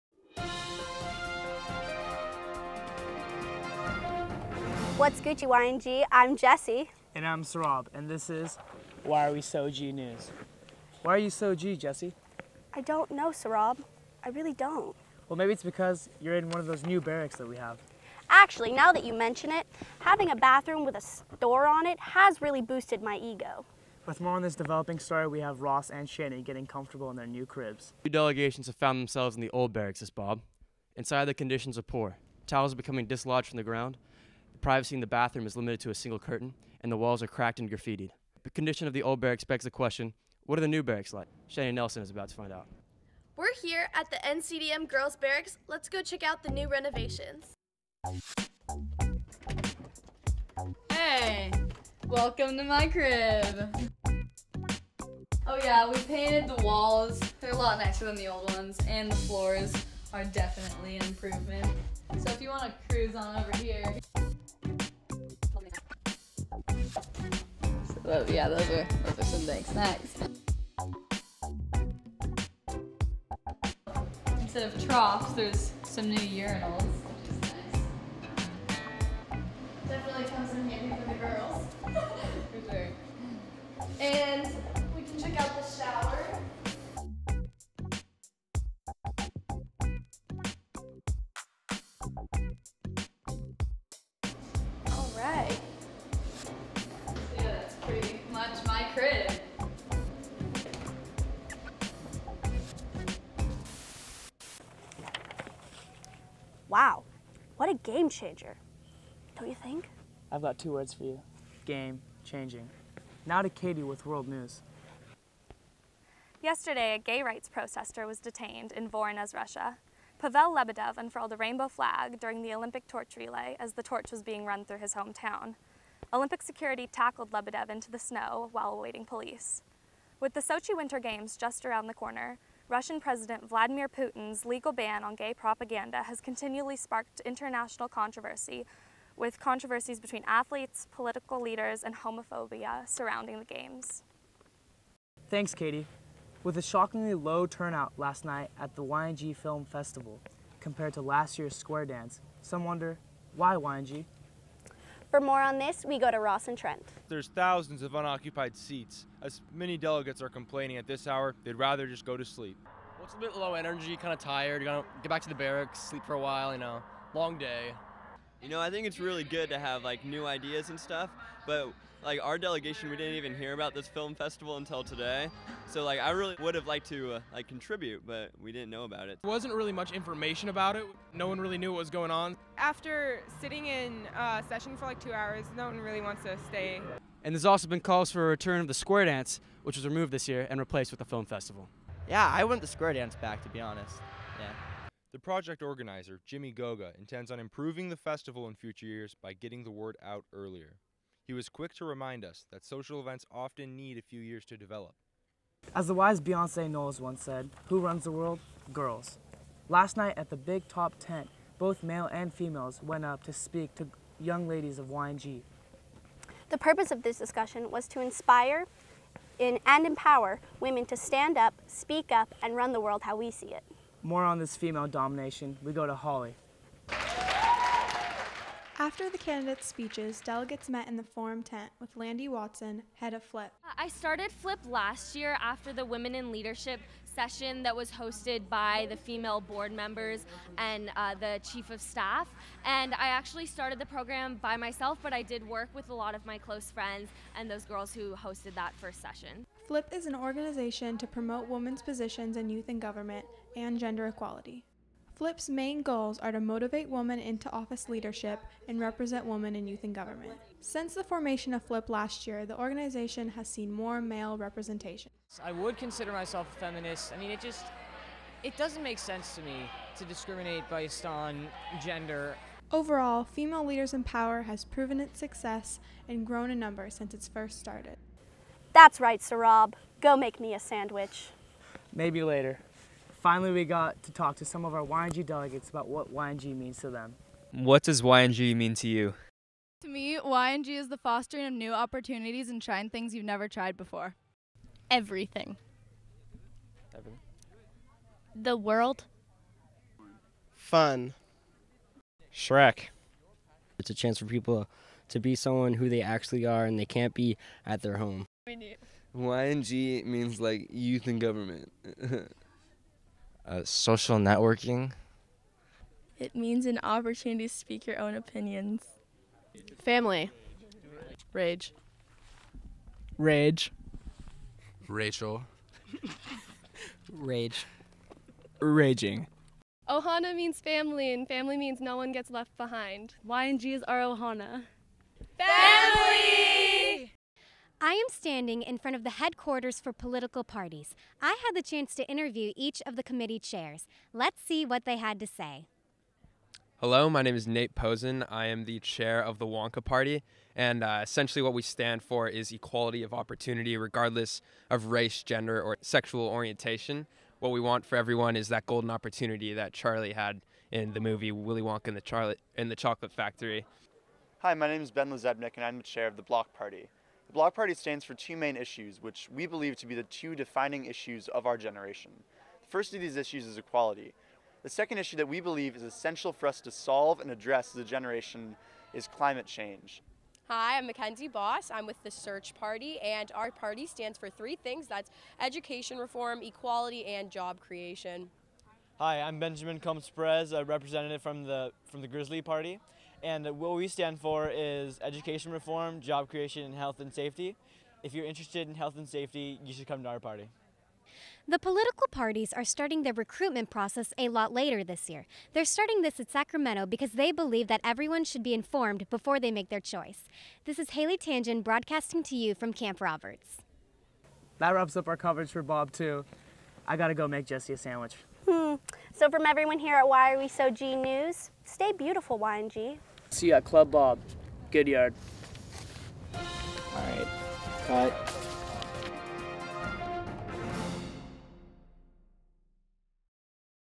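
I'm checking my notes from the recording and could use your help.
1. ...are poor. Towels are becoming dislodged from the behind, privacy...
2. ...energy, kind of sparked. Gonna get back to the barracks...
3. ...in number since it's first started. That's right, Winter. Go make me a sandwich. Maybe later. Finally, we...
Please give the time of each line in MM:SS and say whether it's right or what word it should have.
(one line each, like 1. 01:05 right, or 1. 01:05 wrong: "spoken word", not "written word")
1. 00:31 wrong: "ground", not "behind"
2. 02:43 wrong: "tired", not "sparked"
3. 04:36 wrong: "Sarab", not "Winter".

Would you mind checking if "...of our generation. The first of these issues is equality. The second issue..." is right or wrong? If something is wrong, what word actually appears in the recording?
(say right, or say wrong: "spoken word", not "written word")
right.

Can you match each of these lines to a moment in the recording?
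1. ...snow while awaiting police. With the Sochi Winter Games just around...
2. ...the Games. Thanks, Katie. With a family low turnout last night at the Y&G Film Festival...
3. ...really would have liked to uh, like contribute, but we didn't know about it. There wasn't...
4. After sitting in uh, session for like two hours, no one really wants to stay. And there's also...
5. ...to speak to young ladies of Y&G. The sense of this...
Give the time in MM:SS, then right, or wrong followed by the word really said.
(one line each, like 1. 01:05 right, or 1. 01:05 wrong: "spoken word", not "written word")
1. 02:07 right
2. 02:23 wrong: "shockingly", not "family"
3. 02:56 right
4. 03:02 right
5. 03:33 wrong: "purpose", not "sense".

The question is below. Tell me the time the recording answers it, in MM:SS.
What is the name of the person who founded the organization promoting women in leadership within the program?
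03:51.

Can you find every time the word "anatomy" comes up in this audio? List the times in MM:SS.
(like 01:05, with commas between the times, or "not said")
not said.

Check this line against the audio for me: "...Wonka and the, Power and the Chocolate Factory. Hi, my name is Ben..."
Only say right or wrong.
wrong.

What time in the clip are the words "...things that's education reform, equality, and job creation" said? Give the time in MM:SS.
06:24.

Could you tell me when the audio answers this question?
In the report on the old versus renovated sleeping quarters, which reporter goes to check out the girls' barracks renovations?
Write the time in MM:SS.
00:41.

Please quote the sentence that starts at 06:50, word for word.
This is Haley Tangen broadcasting to you from Camp Roberts.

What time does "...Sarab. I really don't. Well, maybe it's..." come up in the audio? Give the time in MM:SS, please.
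00:13.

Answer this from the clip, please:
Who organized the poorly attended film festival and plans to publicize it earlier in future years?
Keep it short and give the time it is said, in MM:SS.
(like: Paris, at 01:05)
Jimmy Goga, at 03:16.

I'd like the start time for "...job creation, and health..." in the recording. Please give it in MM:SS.
06:36.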